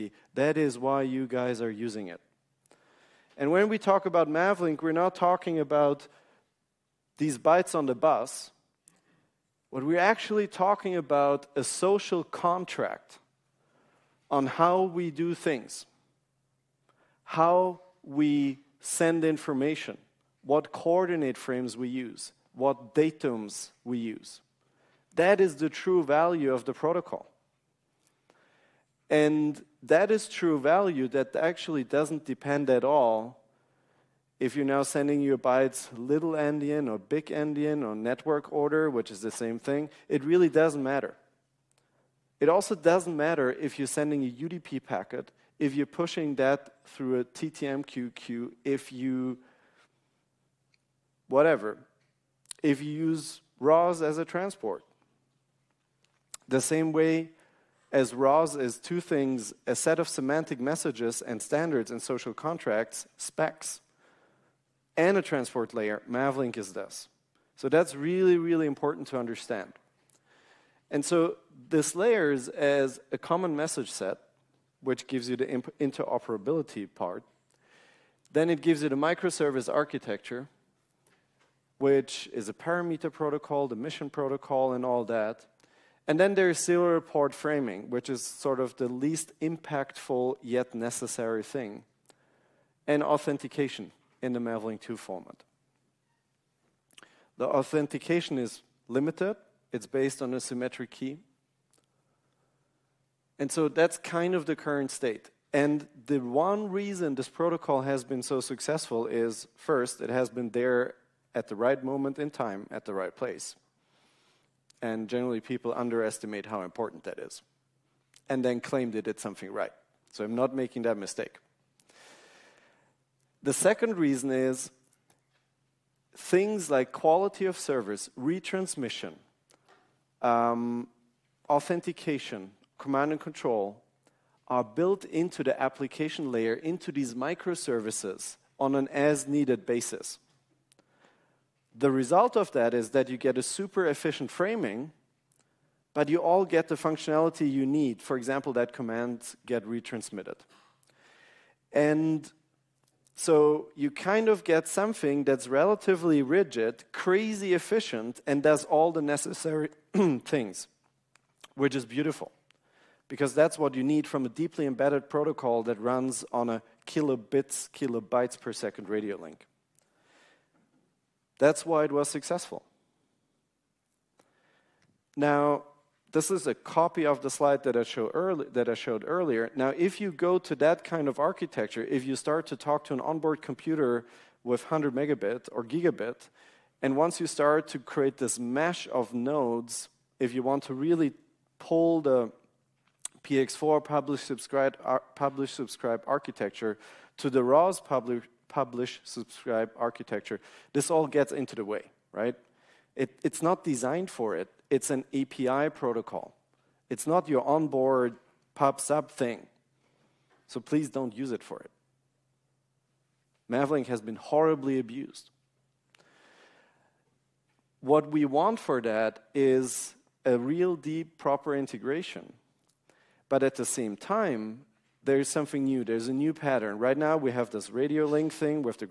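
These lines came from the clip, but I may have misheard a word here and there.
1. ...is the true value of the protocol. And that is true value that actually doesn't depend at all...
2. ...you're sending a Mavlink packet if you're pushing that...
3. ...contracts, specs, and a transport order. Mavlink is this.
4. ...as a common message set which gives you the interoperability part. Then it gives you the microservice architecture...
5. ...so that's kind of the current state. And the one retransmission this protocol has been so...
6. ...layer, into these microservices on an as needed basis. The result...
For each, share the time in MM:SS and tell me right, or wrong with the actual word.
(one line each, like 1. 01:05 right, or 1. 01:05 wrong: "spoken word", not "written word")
1. 00:25 right
2. 00:43 wrong: "UDP", not "Mavlink"
3. 01:02 wrong: "layer", not "order"
4. 01:12 right
5. 01:43 wrong: "reason", not "retransmission"
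6. 02:16 right.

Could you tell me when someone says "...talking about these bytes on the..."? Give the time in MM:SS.
00:05.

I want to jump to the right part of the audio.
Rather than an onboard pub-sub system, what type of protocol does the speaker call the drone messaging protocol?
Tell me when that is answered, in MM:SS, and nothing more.
03:25.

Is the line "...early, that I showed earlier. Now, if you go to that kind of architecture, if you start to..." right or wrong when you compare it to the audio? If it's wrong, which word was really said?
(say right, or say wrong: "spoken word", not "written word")
right.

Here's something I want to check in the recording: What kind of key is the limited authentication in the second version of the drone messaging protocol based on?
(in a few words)
Symmetric key.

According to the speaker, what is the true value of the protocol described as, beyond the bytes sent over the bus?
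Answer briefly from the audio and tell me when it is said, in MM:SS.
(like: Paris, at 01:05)
A social contract, at 00:11.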